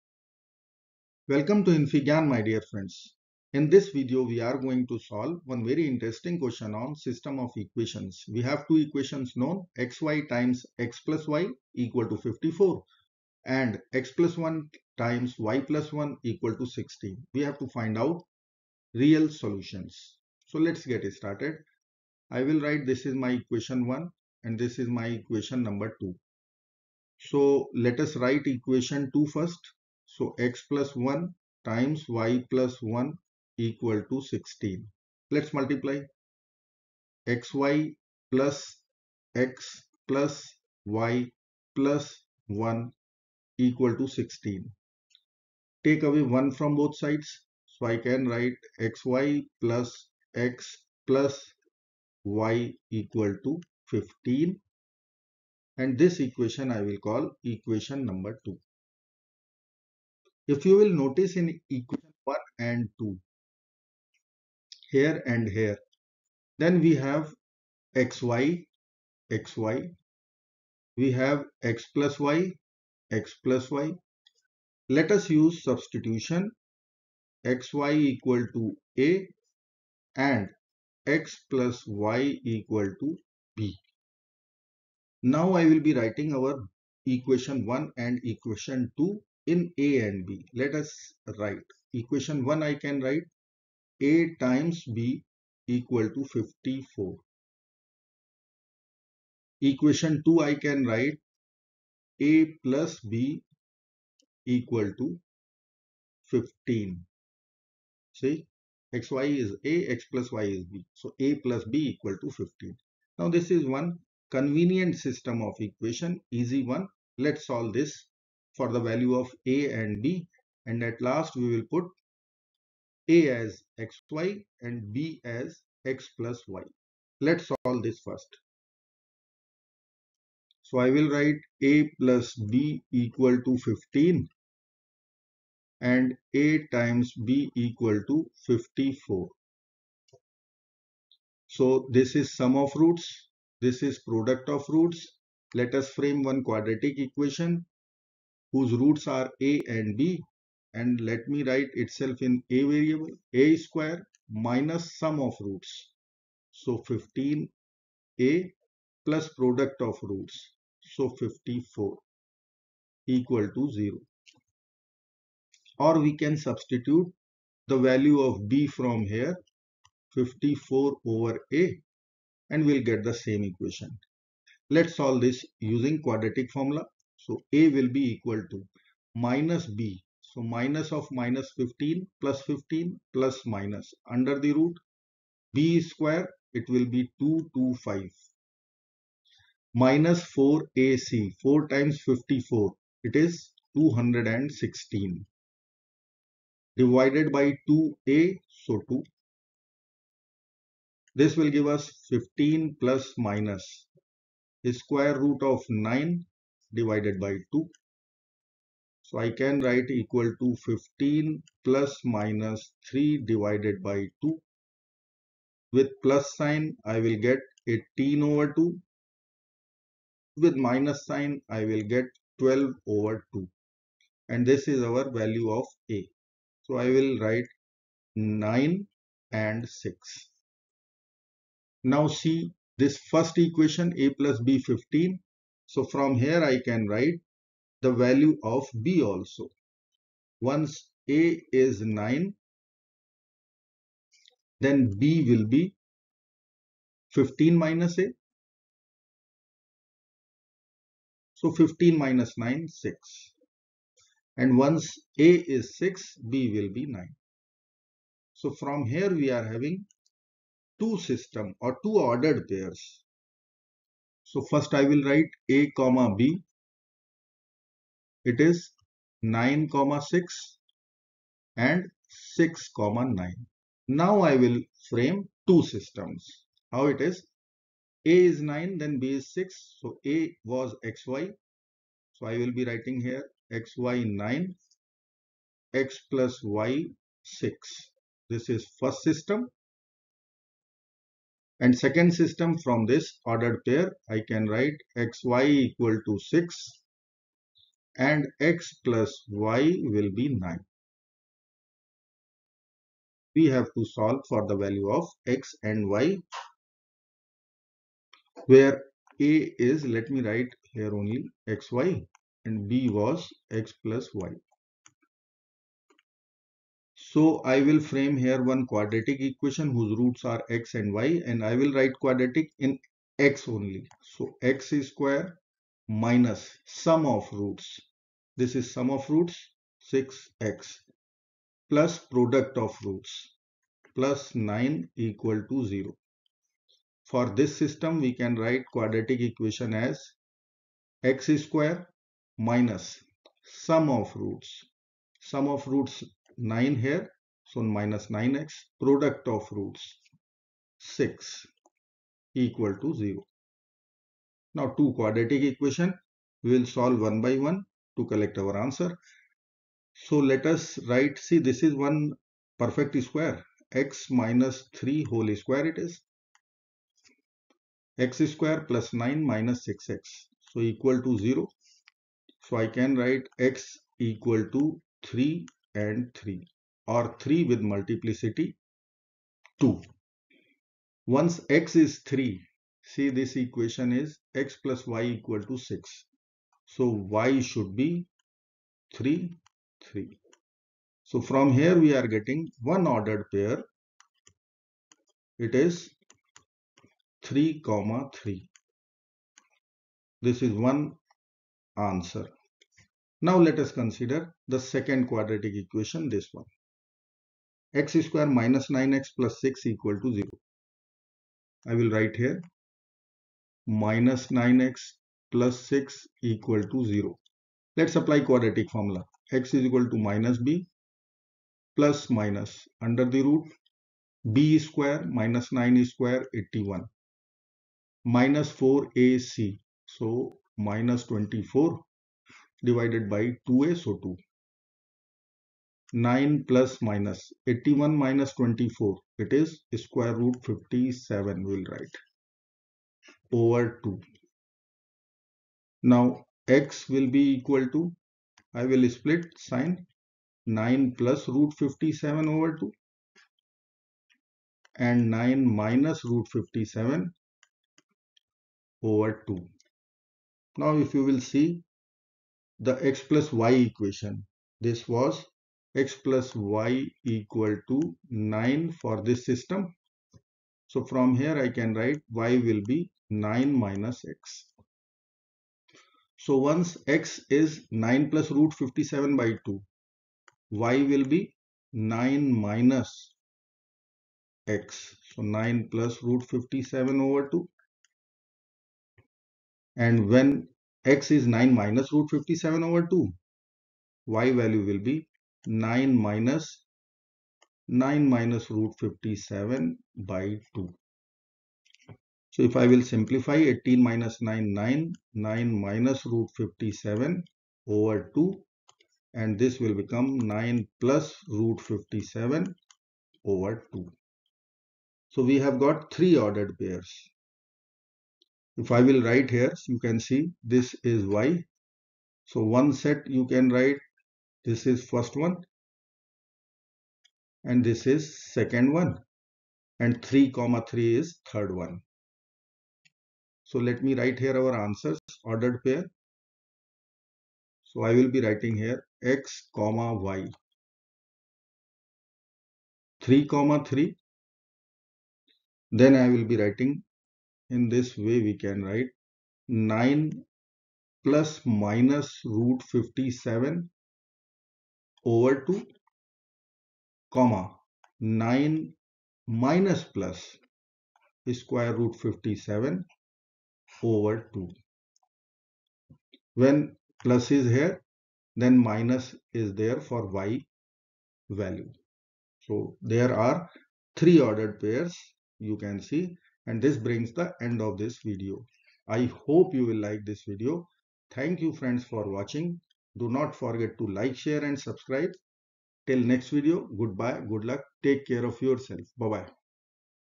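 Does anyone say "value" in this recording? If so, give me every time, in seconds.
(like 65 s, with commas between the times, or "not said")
118 s, 167 s, 225 s, 237 s, 304 s, 494 s, 571 s.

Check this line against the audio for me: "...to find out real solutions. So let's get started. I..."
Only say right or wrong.
right.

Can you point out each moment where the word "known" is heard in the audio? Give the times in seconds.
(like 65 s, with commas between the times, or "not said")
9 s.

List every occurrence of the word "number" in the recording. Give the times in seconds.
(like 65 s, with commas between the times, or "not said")
25 s, 58 s.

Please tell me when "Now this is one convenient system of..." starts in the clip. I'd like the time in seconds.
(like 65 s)
113 s.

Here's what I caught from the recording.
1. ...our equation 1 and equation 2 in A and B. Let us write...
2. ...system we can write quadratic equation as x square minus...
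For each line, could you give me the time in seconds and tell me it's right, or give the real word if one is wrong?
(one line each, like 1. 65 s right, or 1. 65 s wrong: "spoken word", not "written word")
1. 86 s right
2. 337 s right.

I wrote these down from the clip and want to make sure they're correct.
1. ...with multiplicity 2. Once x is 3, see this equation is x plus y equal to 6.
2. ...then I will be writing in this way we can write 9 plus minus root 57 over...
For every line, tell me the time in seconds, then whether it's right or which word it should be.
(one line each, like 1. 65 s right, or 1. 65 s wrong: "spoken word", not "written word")
1. 377 s right
2. 545 s right.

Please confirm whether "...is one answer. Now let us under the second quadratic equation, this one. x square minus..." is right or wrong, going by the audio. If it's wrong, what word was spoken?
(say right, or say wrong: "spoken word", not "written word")
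wrong: "consider", not "under".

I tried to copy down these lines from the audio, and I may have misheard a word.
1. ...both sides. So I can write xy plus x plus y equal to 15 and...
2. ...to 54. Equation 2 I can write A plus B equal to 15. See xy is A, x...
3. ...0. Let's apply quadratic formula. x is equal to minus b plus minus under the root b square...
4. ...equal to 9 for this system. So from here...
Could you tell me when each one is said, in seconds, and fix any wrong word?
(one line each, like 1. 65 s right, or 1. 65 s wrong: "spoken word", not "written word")
1. 46 s right
2. 96 s right
3. 416 s right
4. 467 s right.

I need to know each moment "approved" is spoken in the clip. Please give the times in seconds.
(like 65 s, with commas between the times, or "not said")
not said.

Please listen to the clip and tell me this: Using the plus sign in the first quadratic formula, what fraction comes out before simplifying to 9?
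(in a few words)
18 over 2.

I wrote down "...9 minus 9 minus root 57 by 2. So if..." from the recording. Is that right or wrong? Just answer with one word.
right.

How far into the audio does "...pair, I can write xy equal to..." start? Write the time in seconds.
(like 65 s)
293 s.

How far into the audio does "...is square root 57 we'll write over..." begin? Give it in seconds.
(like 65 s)
439 s.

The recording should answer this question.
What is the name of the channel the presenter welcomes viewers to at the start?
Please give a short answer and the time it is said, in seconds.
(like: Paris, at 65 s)
infyGyan, at 1 s.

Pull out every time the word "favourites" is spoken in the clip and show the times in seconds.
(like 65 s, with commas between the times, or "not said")
not said.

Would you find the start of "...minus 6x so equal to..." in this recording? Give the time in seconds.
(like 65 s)
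369 s.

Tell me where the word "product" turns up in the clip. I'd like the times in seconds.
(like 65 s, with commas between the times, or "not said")
144 s, 159 s, 331 s, 348 s.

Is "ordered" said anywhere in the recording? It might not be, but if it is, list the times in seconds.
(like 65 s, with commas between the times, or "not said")
261 s, 293 s, 392 s, 516 s, 535 s, 574 s.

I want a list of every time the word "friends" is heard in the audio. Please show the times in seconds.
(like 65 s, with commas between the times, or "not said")
2 s, 581 s.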